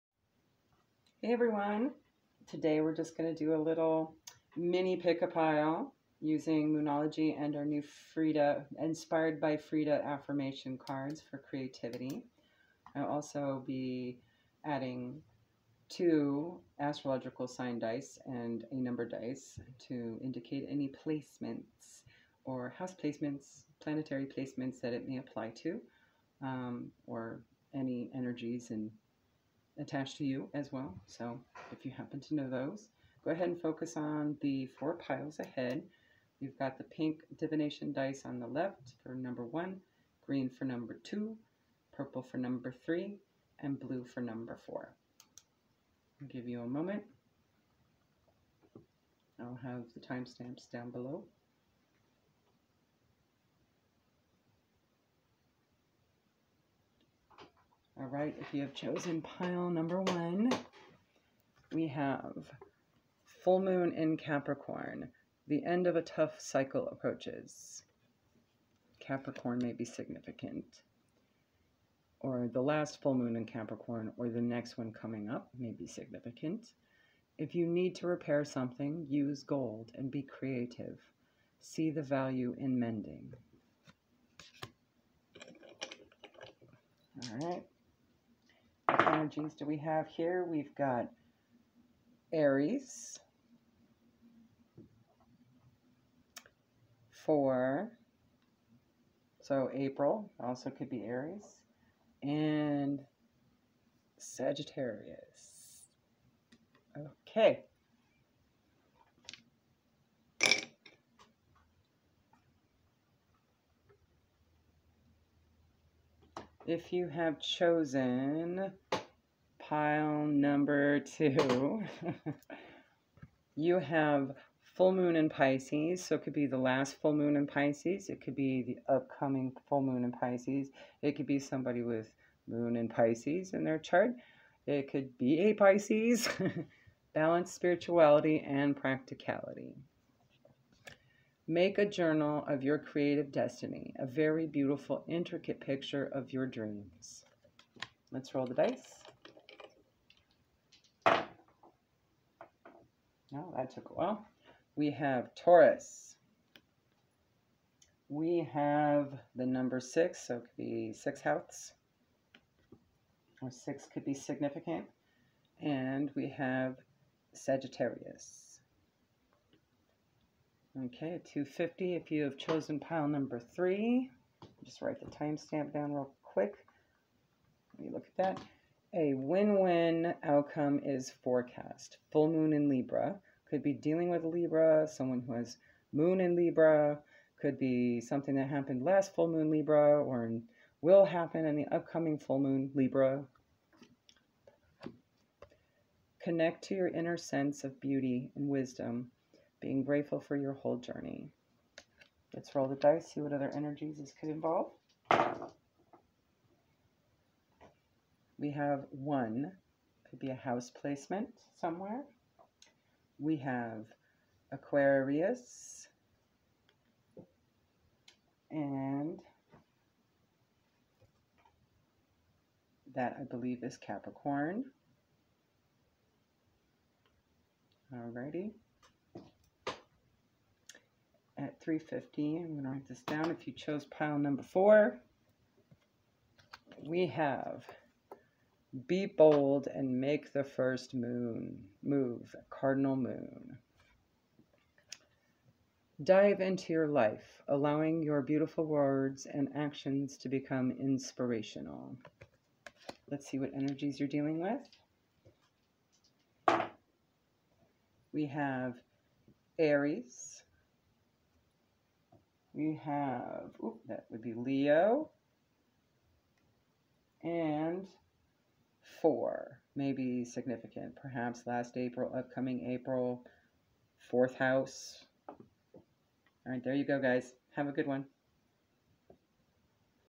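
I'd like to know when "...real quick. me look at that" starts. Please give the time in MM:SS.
02:55.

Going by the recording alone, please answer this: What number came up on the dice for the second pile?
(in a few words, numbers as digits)
6.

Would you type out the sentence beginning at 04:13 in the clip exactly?
Let's see what energies you're dealing with.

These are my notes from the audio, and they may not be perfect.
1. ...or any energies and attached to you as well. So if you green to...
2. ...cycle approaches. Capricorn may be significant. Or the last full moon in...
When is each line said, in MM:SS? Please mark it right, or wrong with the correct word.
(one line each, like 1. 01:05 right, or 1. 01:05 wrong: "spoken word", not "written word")
1. 00:27 wrong: "happen", not "green"
2. 01:06 right.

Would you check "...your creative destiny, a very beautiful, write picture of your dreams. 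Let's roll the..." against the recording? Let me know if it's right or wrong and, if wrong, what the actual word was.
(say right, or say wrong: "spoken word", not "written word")
wrong: "intricate", not "write".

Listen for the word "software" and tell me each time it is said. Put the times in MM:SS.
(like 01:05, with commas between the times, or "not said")
not said.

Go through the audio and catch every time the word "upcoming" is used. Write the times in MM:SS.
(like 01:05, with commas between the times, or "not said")
02:08, 03:11, 04:32.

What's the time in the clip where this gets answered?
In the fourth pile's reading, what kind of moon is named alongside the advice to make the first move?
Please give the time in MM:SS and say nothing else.
04:02.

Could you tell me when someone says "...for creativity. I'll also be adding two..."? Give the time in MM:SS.
00:11.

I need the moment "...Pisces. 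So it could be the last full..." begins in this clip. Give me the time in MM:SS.
02:05.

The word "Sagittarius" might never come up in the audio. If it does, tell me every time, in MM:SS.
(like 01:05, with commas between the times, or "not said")
01:44, 02:47.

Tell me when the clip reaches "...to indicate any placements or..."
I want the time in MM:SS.
00:19.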